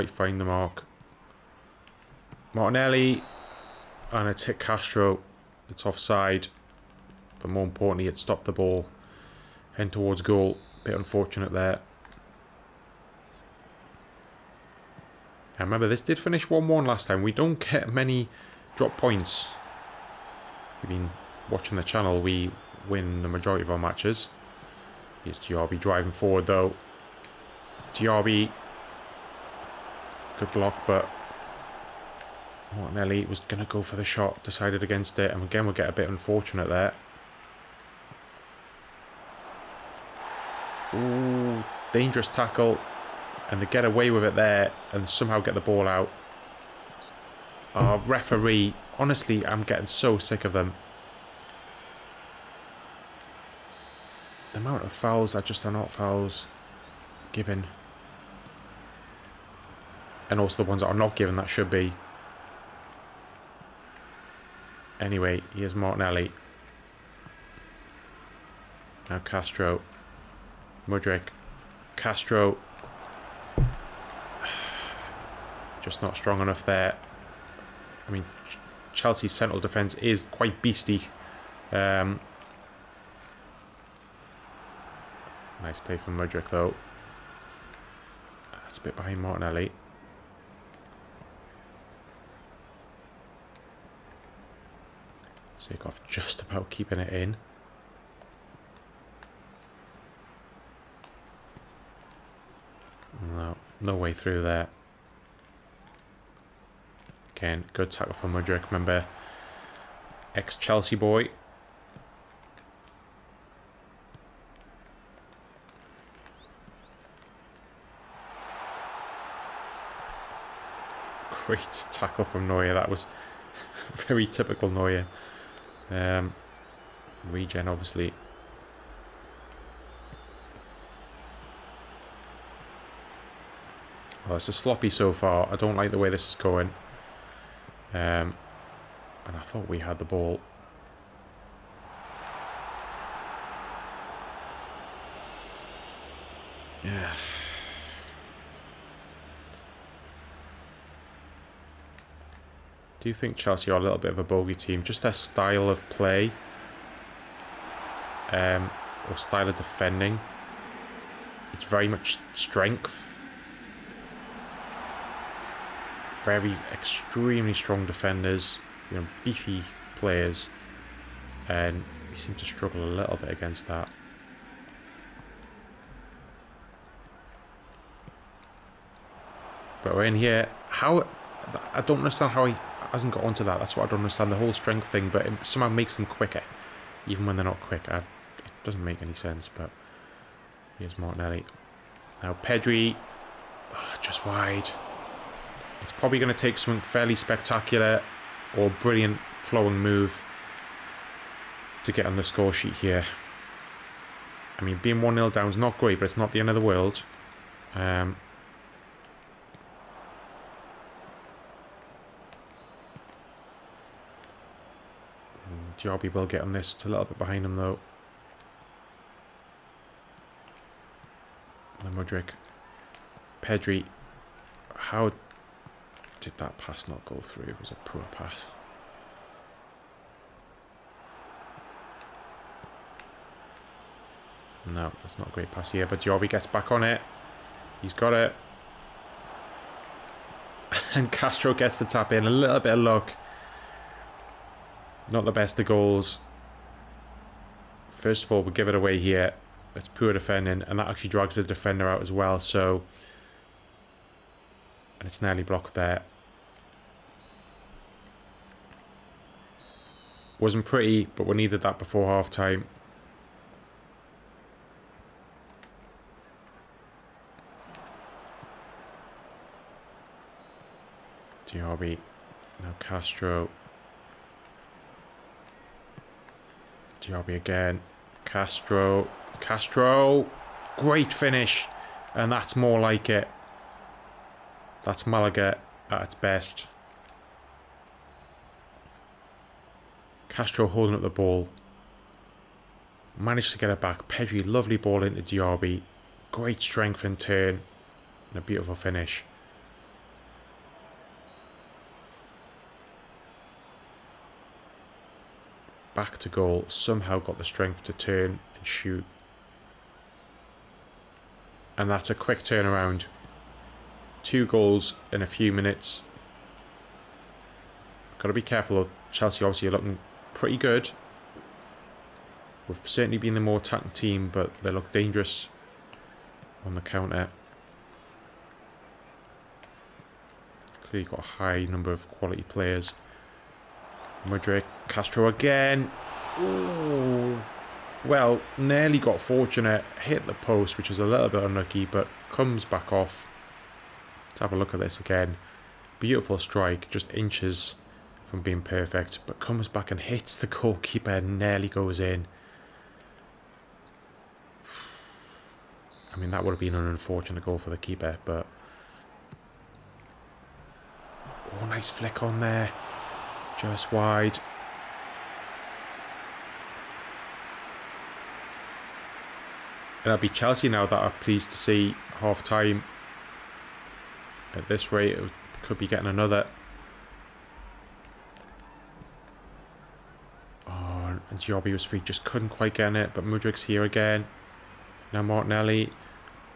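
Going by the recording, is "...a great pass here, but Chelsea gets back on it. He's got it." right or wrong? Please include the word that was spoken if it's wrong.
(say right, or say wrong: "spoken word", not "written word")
wrong: "Diaby", not "Chelsea".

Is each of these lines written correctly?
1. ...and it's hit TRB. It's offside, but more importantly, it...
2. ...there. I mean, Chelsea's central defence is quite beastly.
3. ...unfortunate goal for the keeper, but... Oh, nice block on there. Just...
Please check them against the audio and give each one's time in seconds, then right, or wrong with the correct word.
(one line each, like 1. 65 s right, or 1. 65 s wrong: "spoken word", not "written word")
1. 4 s wrong: "Castro", not "TRB"
2. 76 s right
3. 356 s wrong: "flick", not "block".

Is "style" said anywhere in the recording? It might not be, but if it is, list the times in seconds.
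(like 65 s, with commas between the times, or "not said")
155 s, 159 s.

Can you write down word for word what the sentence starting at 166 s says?
Very extremely strong defenders, you know, beefy players, and we seem to struggle a little bit against that.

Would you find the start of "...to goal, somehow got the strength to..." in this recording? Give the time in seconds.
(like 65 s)
306 s.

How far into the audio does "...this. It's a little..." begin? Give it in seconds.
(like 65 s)
216 s.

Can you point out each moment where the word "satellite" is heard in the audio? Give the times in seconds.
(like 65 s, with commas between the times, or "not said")
not said.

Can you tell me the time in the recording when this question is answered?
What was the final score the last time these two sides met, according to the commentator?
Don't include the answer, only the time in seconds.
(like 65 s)
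16 s.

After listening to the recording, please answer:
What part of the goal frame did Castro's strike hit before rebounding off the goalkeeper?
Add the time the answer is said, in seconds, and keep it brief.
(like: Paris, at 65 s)
the post, at 340 s.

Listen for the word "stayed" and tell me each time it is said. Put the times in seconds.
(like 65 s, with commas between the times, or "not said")
not said.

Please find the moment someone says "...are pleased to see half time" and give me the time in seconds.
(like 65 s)
370 s.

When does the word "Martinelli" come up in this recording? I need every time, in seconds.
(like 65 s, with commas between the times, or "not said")
2 s, 32 s, 65 s, 89 s, 190 s, 385 s.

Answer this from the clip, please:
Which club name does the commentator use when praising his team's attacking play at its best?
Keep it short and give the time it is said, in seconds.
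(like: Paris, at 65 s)
Malaga, at 285 s.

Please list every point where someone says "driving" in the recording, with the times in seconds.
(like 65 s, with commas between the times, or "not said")
25 s.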